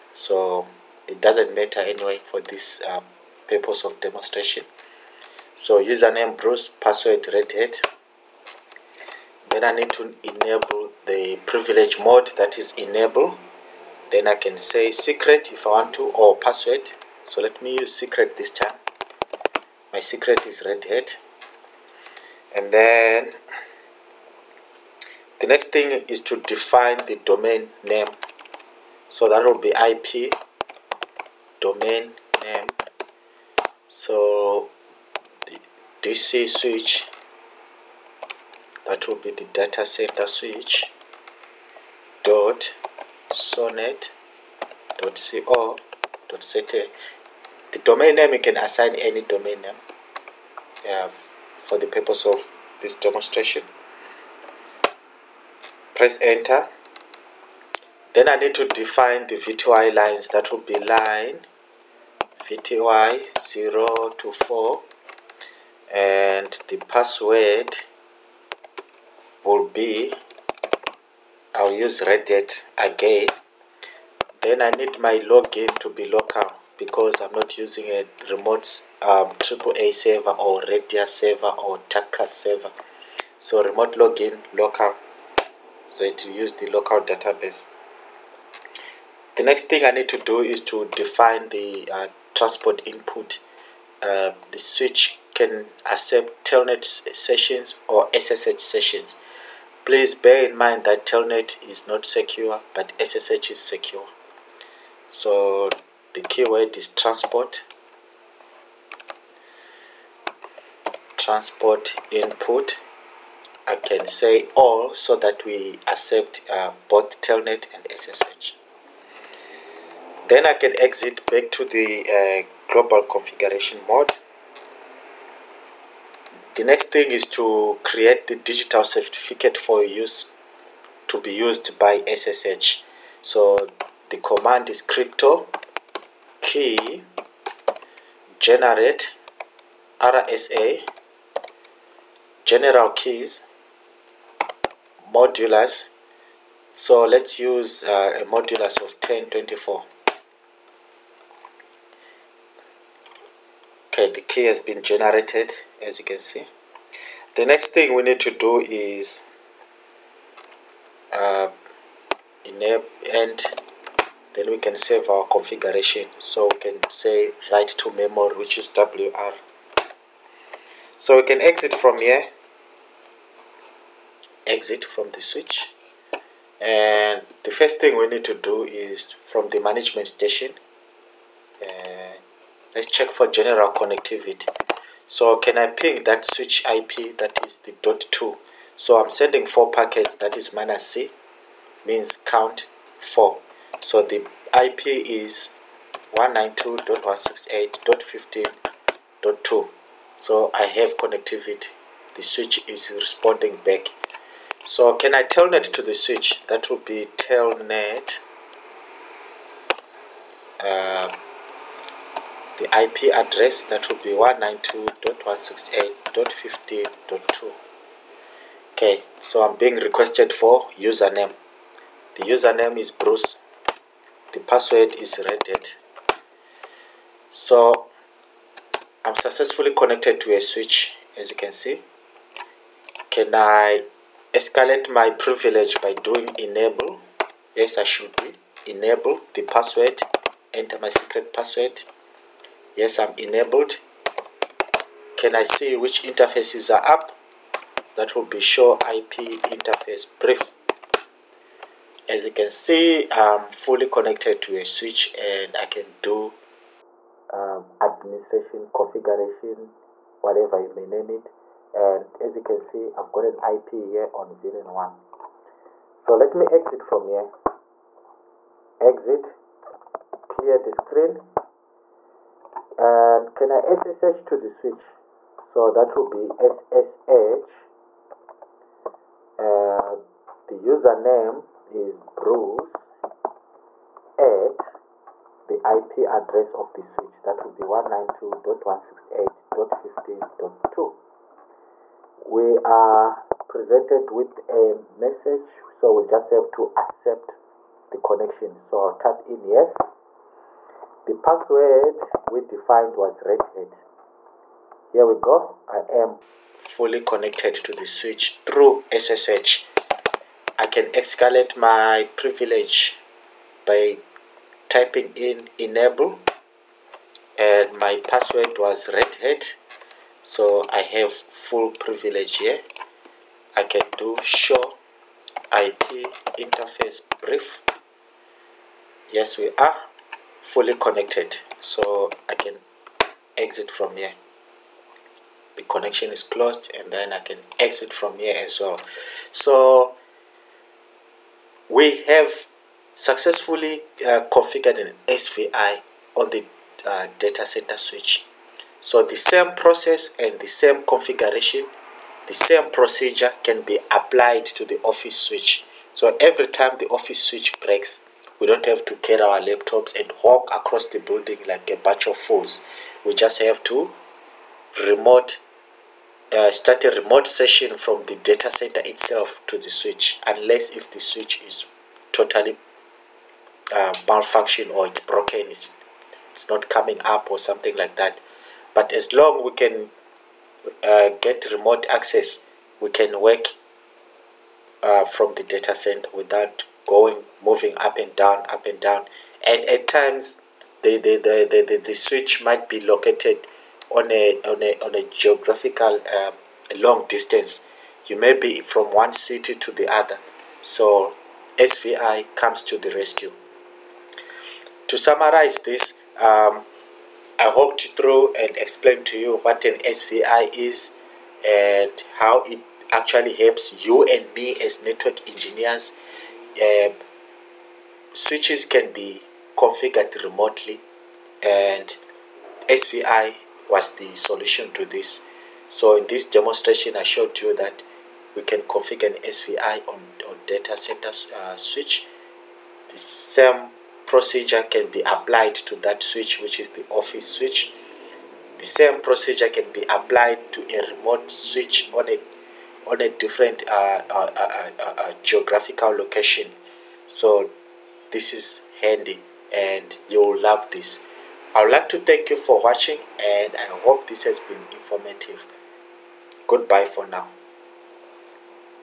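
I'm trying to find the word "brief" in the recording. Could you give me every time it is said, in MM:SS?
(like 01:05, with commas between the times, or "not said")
04:10, 05:27.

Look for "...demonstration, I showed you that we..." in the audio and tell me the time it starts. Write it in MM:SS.
07:06.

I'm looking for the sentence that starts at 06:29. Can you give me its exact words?
And at times, the, the, the, the, the switch might be located on a, on a, on a geographical um, long distance.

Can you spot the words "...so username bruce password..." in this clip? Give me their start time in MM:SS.
00:05.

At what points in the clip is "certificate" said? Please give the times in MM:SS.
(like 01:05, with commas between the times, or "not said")
02:08.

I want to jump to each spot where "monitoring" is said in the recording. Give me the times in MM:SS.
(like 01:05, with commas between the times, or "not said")
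not said.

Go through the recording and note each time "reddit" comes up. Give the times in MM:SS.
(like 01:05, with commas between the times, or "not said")
01:12, 03:45.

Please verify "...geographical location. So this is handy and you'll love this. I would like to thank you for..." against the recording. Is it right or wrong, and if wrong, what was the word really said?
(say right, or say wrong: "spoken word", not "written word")
right.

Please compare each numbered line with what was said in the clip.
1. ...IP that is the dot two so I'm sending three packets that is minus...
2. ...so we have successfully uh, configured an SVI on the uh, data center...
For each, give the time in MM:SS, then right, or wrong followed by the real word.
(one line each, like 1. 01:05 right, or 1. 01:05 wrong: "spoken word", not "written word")
1. 03:06 wrong: "four", not "three"
2. 05:39 right.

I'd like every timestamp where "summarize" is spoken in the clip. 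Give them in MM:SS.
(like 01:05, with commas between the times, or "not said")
06:44.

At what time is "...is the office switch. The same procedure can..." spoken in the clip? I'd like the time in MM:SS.
07:16.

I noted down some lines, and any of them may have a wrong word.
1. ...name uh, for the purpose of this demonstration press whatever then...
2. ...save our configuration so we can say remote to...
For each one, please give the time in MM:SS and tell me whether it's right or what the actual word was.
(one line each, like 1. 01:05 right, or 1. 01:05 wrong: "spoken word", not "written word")
1. 00:49 wrong: "enter", not "whatever"
2. 02:44 wrong: "write", not "remote".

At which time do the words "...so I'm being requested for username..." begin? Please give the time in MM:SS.
03:39.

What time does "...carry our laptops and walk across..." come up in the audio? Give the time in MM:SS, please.
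05:58.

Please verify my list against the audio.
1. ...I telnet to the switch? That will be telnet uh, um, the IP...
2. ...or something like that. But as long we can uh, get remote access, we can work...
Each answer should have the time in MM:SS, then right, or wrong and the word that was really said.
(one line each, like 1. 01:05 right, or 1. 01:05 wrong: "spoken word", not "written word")
1. 03:25 right
2. 06:17 right.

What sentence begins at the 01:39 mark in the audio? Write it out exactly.
Please bear in mind that telnet is not secure, but SSH is secure.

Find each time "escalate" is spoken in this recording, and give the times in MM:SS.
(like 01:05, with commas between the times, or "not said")
03:54, 05:10.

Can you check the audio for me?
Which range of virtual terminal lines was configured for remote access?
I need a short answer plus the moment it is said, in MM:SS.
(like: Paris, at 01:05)
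VTY 0 to 4, at 01:02.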